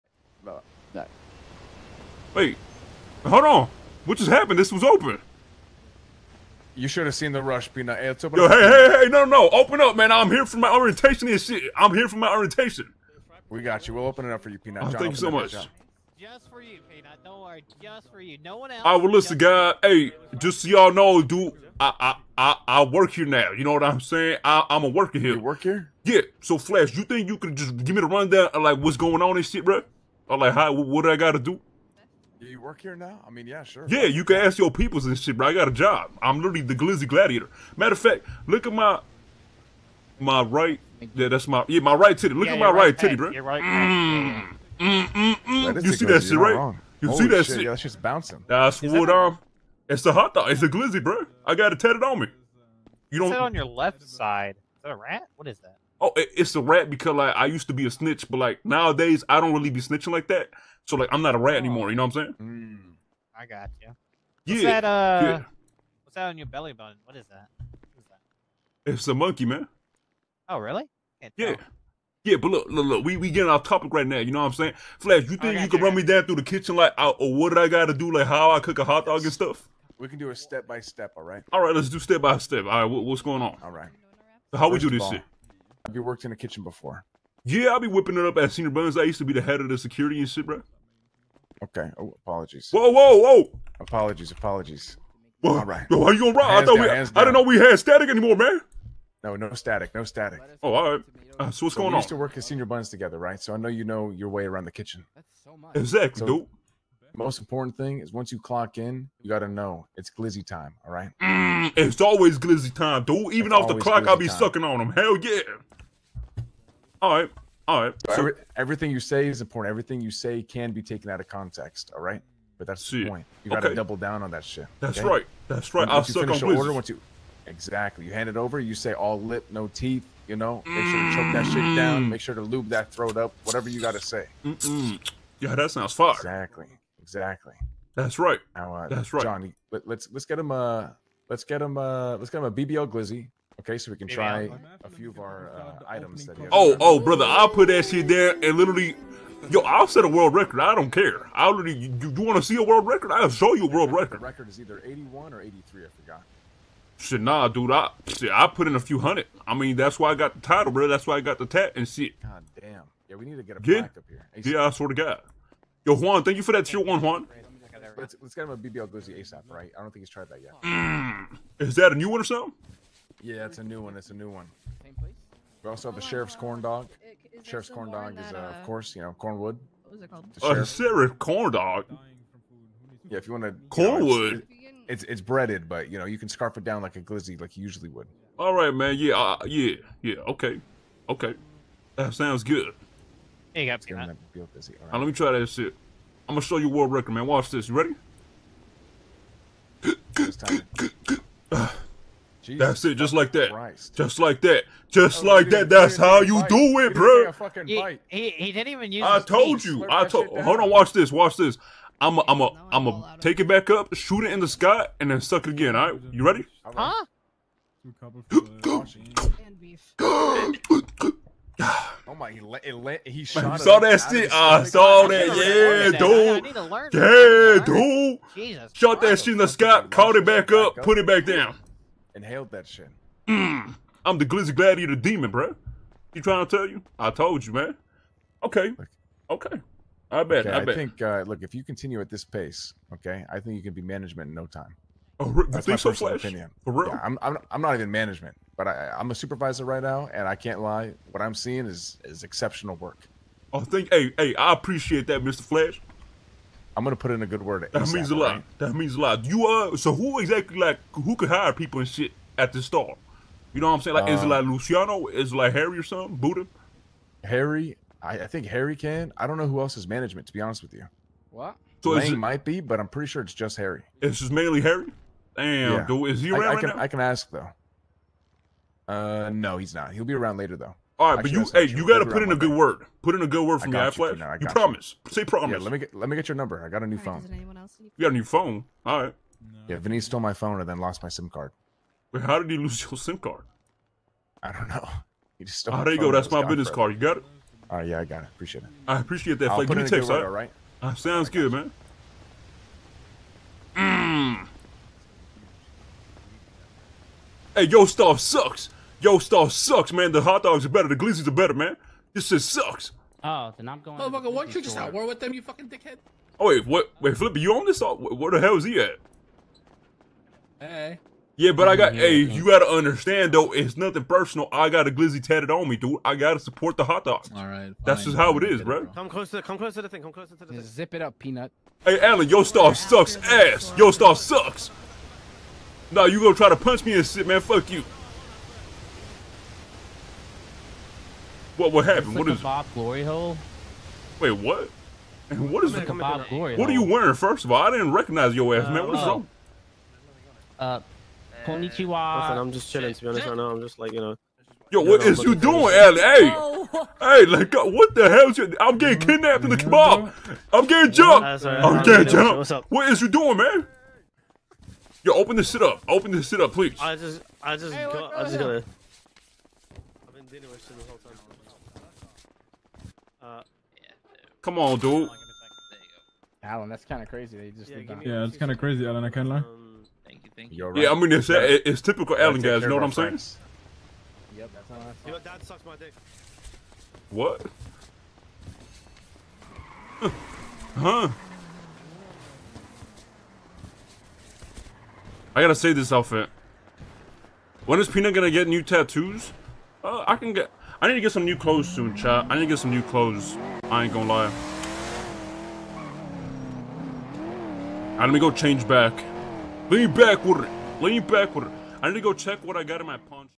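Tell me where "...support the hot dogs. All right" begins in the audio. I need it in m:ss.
5:26.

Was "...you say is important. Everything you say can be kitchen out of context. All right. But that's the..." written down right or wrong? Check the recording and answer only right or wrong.
wrong.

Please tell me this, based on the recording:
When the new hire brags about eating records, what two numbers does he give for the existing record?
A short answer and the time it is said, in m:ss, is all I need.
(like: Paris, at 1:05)
81 or 83, at 2:34.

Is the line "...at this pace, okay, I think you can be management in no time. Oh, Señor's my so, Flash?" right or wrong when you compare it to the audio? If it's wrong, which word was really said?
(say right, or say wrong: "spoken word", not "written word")
wrong: "That", not "Señor".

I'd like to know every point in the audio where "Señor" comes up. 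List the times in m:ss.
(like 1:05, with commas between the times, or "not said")
1:28, 1:42.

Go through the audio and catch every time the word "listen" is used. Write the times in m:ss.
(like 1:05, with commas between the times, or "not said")
0:19, 5:51.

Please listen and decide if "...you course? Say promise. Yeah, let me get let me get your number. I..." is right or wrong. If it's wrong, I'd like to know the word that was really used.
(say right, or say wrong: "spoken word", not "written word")
wrong: "promise", not "course".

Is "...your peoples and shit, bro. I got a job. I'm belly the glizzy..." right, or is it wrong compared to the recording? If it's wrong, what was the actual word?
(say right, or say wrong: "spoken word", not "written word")
wrong: "literally", not "belly".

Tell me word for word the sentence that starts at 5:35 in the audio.
Nah, you gonna try to punch me and shit, man?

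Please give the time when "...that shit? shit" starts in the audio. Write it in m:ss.
0:47.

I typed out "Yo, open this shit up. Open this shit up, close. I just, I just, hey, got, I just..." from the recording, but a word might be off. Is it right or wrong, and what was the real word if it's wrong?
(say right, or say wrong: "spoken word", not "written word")
wrong: "please", not "close".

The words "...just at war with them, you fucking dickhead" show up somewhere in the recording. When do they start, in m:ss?
5:14.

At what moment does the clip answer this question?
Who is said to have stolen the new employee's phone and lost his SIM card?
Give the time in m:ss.
4:49.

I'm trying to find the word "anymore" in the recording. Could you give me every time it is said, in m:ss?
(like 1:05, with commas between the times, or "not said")
1:01, 1:38.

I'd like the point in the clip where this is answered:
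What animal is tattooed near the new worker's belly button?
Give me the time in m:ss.
1:09.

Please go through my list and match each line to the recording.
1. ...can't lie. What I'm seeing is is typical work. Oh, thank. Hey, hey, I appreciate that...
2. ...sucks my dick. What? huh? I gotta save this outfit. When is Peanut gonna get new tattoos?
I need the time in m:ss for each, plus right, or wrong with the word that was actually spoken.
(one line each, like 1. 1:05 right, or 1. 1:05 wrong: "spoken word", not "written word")
1. 4:10 wrong: "exceptional", not "typical"
2. 6:25 right.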